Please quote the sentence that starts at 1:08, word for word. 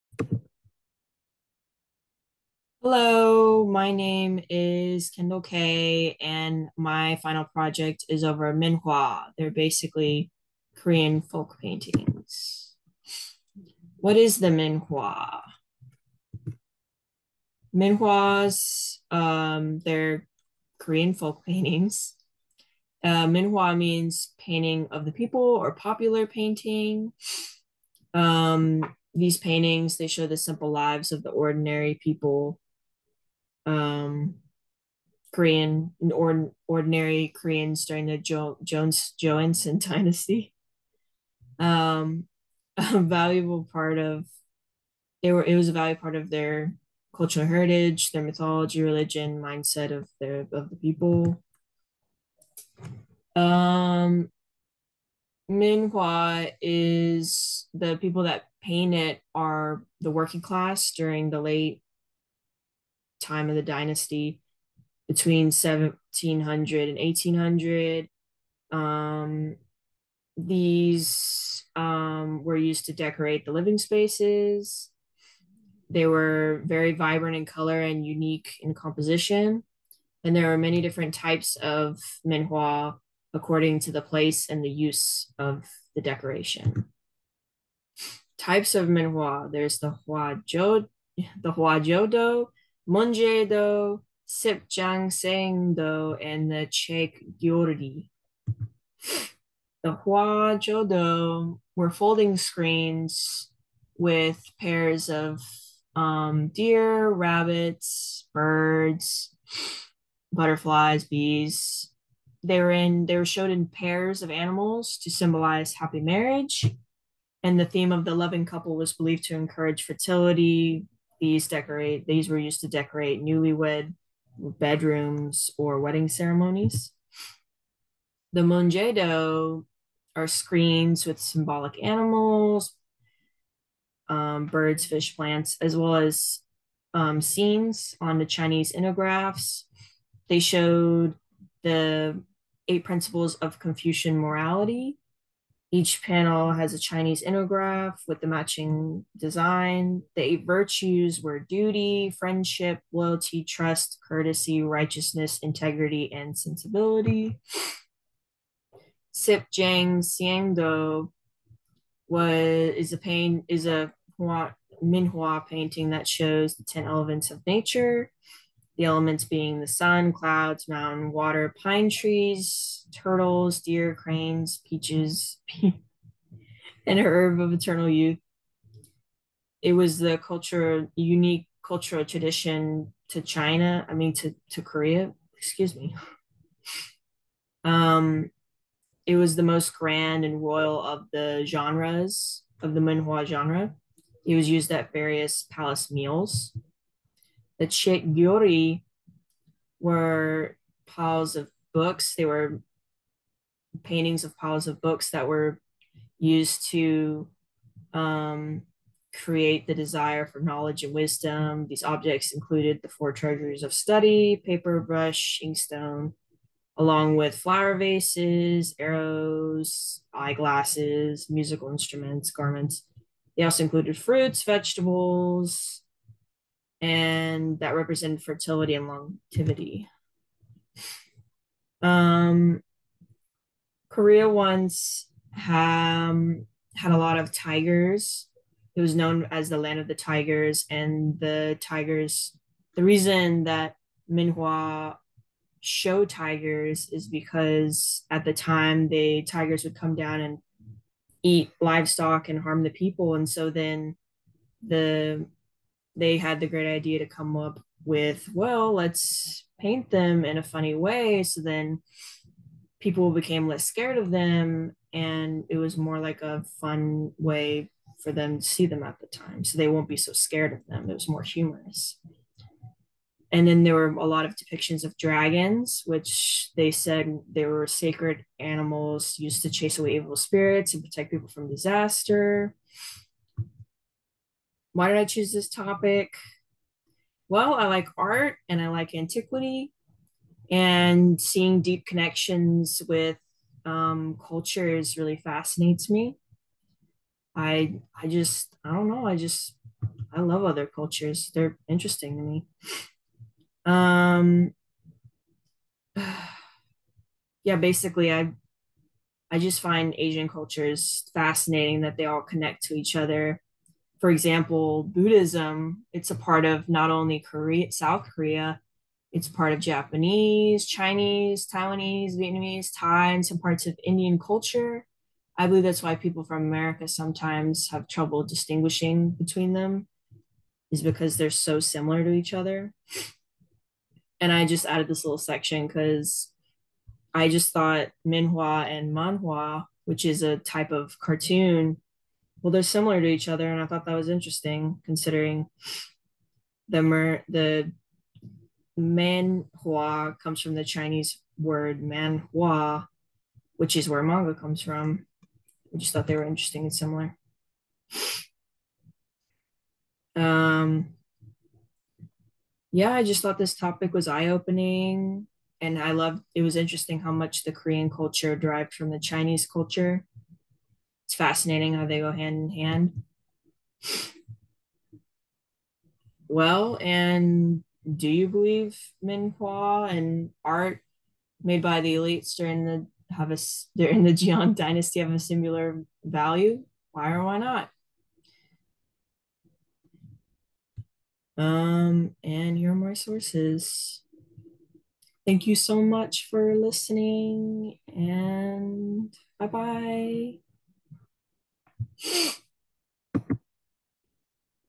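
Um, these um, were used to decorate the living spaces.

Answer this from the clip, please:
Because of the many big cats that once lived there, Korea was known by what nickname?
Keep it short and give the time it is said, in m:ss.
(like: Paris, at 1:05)
land of the tigers, at 3:59.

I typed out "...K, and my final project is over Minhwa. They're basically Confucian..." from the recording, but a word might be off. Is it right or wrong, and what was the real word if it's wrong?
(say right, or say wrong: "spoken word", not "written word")
wrong: "Korean", not "Confucian".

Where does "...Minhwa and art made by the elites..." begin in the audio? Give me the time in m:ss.
6:19.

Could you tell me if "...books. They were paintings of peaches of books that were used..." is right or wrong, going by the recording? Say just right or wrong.
wrong.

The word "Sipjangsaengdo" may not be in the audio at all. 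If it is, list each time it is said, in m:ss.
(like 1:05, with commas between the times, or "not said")
1:34, 2:39.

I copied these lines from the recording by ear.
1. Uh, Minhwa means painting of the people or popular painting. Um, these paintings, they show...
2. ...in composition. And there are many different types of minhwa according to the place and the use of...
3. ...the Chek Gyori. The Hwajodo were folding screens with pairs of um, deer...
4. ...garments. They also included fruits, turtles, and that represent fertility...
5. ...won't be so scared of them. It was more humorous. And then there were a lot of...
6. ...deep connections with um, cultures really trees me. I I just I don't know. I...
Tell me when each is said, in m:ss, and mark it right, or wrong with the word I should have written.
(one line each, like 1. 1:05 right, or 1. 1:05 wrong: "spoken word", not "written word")
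1. 0:23 right
2. 1:18 right
3. 1:36 right
4. 3:42 wrong: "vegetables", not "turtles"
5. 4:29 right
6. 4:51 wrong: "fascinates", not "trees".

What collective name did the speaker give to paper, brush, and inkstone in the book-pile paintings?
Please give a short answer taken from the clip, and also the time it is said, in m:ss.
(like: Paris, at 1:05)
four treasures of study, at 3:32.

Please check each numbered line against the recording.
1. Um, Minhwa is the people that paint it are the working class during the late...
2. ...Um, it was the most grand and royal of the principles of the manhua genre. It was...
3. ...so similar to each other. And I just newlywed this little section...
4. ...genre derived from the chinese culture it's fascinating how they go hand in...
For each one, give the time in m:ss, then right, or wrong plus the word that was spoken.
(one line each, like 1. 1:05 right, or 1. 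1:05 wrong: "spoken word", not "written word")
1. 0:53 right
2. 3:07 wrong: "genres", not "principles"
3. 5:31 wrong: "added", not "newlywed"
4. 6:07 wrong: "culture", not "genre".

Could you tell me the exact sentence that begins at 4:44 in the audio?
Why did I choose this topic?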